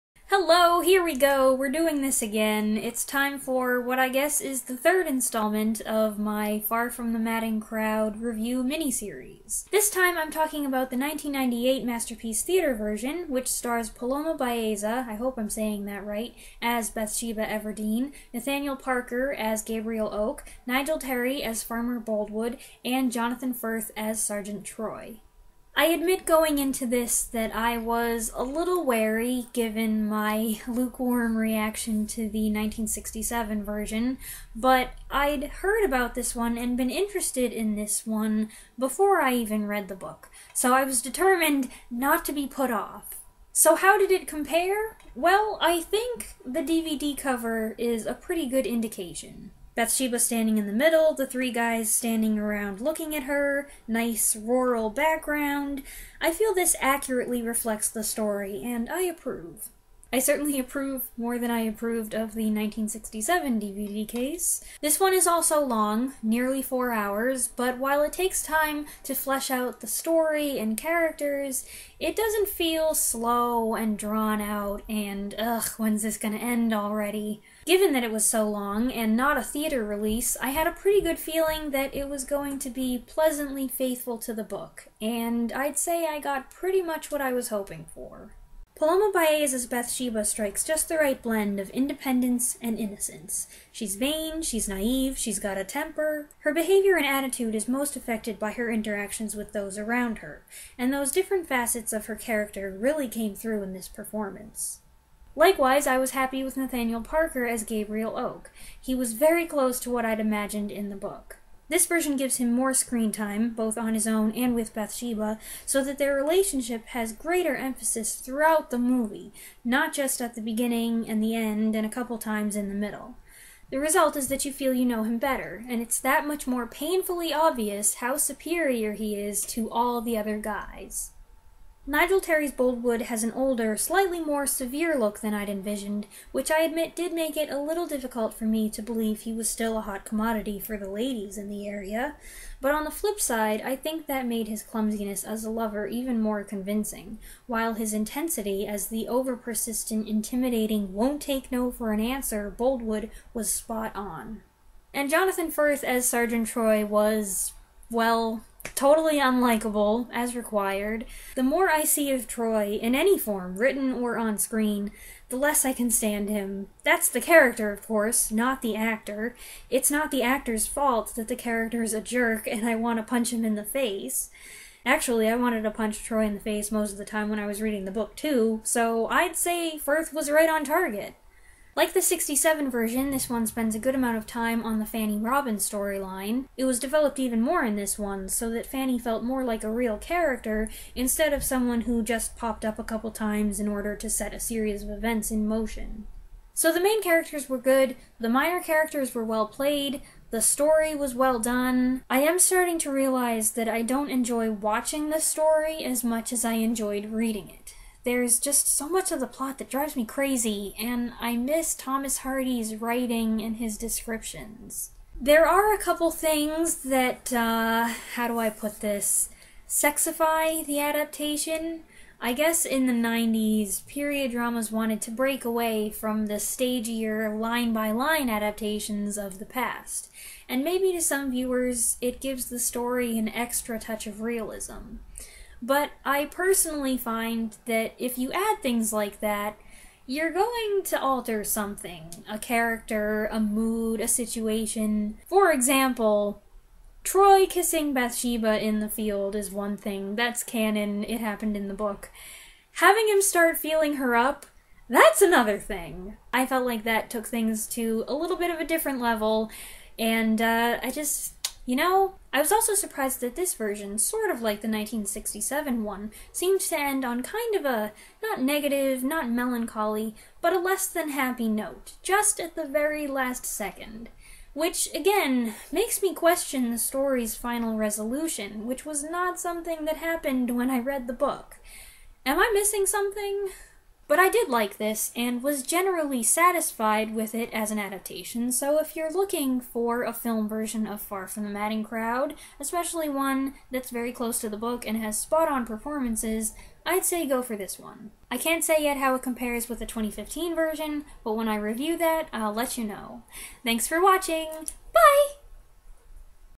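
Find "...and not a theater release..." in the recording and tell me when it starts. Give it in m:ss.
1:18.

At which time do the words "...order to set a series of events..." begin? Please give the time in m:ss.
3:13.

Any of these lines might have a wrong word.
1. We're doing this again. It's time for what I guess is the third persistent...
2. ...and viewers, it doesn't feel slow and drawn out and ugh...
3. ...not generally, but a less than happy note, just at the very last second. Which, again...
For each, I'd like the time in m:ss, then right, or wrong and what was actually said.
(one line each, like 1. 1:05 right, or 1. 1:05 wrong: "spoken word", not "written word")
1. 0:01 wrong: "installment", not "persistent"
2. 1:10 wrong: "characters", not "viewers"
3. 4:29 wrong: "melancholy", not "generally".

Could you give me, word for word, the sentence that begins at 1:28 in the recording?
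Paloma Baeza's Bathsheba strikes just the right blend of independence and innocence.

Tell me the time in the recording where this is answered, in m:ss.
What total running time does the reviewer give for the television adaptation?
1:06.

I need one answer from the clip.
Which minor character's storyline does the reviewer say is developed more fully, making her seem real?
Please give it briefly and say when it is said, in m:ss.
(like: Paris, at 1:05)
Fanny Robbins, at 3:04.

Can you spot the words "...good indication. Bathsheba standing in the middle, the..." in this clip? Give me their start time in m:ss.
0:48.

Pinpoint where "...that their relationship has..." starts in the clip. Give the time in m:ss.
1:55.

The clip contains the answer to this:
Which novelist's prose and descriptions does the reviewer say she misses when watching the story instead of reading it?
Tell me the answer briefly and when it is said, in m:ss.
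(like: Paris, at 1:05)
Thomas Hardy, at 3:31.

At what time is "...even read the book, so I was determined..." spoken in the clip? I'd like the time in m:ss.
0:39.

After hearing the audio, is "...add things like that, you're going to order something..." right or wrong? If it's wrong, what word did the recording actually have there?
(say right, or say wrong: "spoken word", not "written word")
wrong: "alter", not "order".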